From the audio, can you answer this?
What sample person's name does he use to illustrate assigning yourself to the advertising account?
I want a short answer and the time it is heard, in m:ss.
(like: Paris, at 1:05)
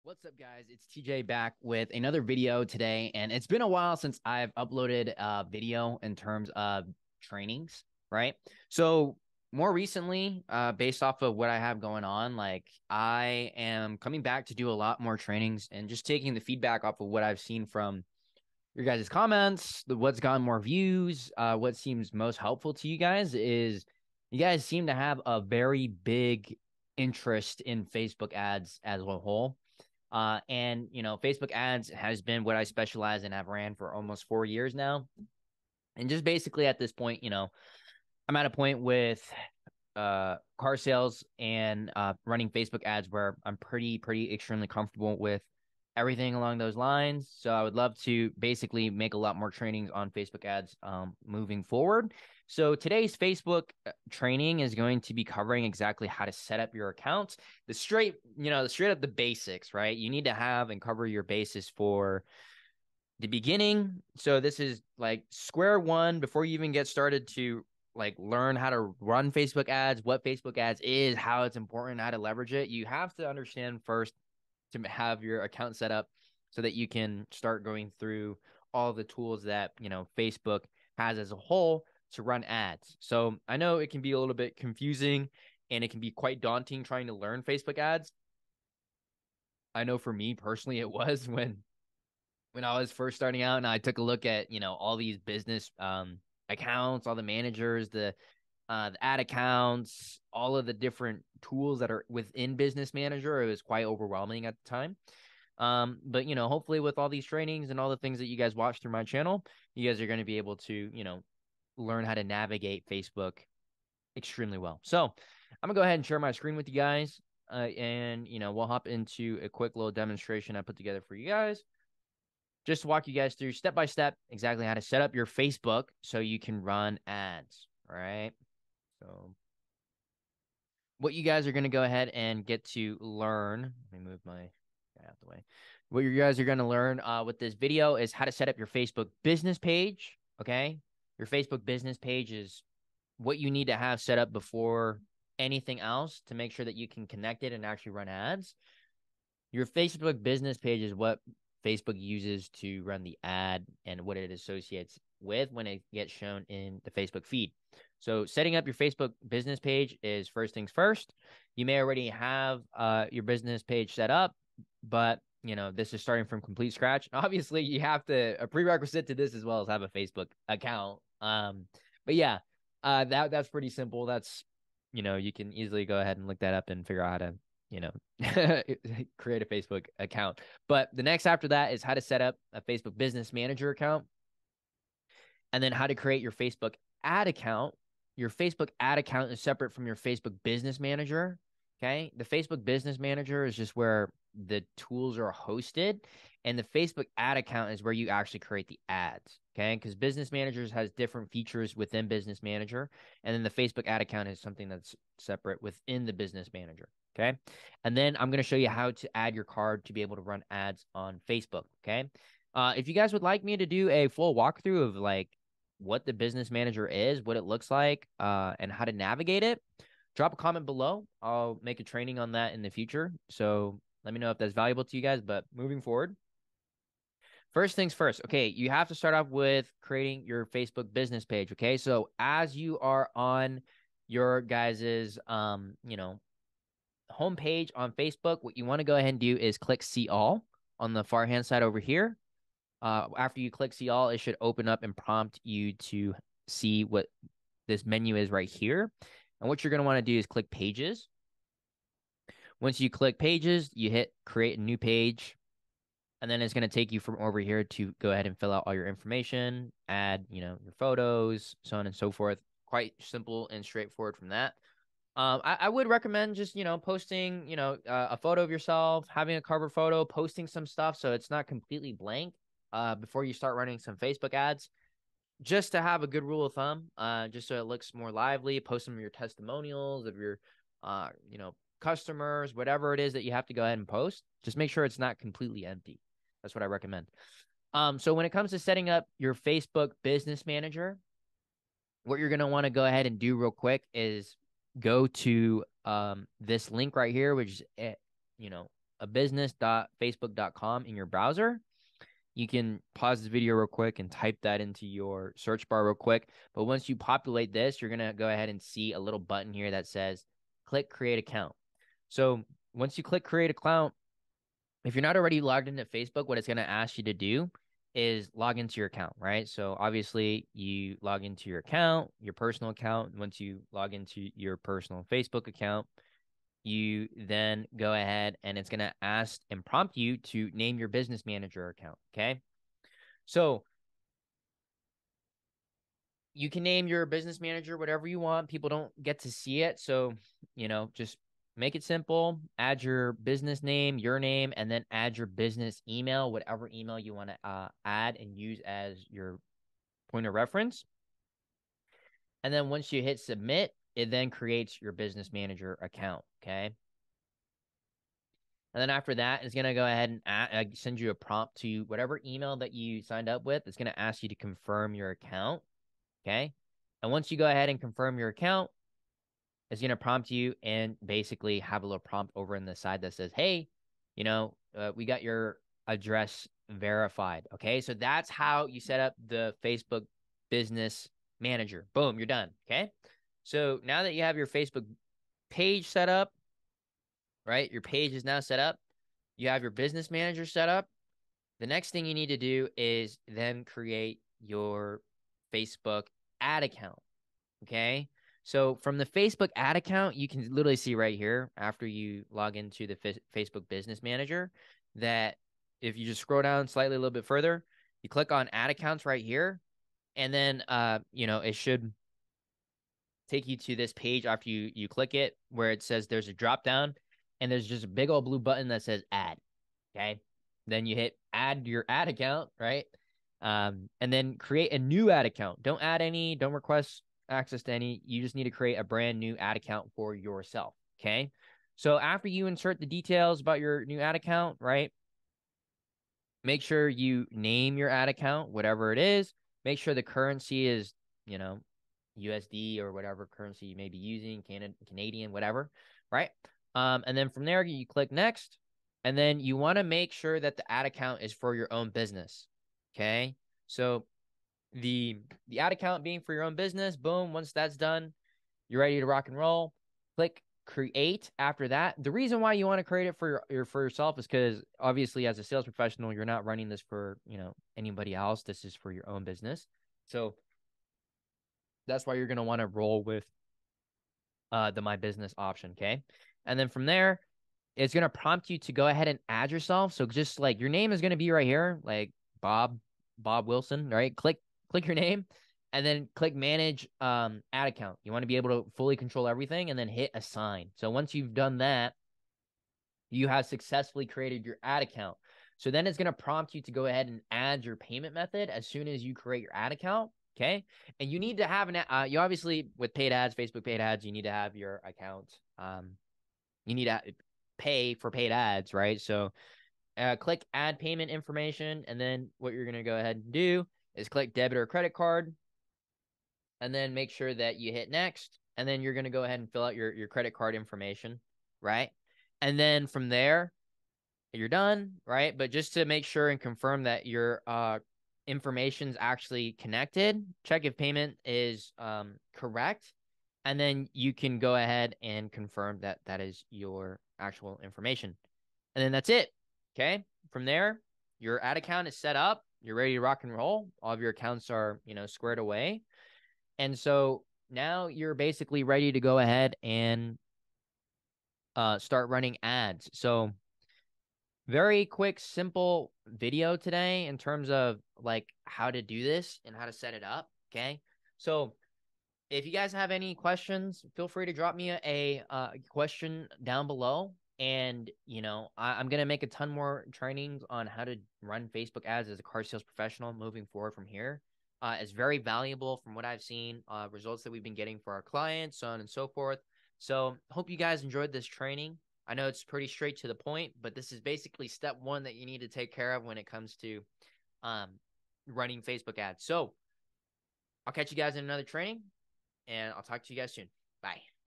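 Bob Wilson, at 8:03.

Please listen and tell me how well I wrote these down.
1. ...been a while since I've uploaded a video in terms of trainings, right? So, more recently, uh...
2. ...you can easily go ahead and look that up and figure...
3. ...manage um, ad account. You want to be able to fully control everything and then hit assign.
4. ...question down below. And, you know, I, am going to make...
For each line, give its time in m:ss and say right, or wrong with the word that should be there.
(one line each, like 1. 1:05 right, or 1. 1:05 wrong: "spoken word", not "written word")
1. 0:03 right
2. 2:55 right
3. 8:06 right
4. 9:25 right.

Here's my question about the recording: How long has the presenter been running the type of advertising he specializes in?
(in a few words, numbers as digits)
almost 4 years.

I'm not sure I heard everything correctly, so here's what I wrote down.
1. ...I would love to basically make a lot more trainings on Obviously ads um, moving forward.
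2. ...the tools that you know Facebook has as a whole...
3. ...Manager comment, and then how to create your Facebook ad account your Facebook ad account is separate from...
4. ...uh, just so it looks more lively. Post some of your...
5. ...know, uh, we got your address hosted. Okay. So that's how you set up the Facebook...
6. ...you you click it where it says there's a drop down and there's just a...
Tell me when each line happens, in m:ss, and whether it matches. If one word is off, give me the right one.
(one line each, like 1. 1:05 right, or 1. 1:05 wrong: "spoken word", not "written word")
1. 0:47 wrong: "Facebook", not "Obviously"
2. 1:18 right
3. 3:03 wrong: "account", not "comment"
4. 4:36 right
5. 6:14 wrong: "verified", not "hosted"
6. 6:54 right.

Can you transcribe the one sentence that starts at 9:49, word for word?
So I'll catch you guys in another training and I'll talk to you guys soon.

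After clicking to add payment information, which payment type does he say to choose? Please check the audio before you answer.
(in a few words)
debit or credit card.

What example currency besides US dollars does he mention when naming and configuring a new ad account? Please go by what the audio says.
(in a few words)
Canadian.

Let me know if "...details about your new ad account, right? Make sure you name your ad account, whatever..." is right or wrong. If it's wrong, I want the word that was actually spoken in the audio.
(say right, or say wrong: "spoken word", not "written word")
right.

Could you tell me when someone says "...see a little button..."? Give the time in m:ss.
5:08.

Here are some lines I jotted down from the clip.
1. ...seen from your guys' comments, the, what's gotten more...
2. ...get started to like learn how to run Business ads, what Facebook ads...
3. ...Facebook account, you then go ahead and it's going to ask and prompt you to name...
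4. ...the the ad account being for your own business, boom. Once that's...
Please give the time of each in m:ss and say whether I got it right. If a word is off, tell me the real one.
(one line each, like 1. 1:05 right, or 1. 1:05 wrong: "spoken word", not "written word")
1. 0:17 right
2. 1:06 wrong: "Facebook", not "Business"
3. 5:25 right
4. 7:34 right.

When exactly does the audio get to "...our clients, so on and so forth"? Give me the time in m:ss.
9:37.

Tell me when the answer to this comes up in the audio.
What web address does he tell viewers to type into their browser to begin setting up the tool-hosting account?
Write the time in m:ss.
4:59.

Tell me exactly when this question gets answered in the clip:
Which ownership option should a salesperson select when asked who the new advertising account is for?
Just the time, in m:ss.
7:54.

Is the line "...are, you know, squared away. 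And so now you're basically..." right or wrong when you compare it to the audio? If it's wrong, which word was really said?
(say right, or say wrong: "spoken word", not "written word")
right.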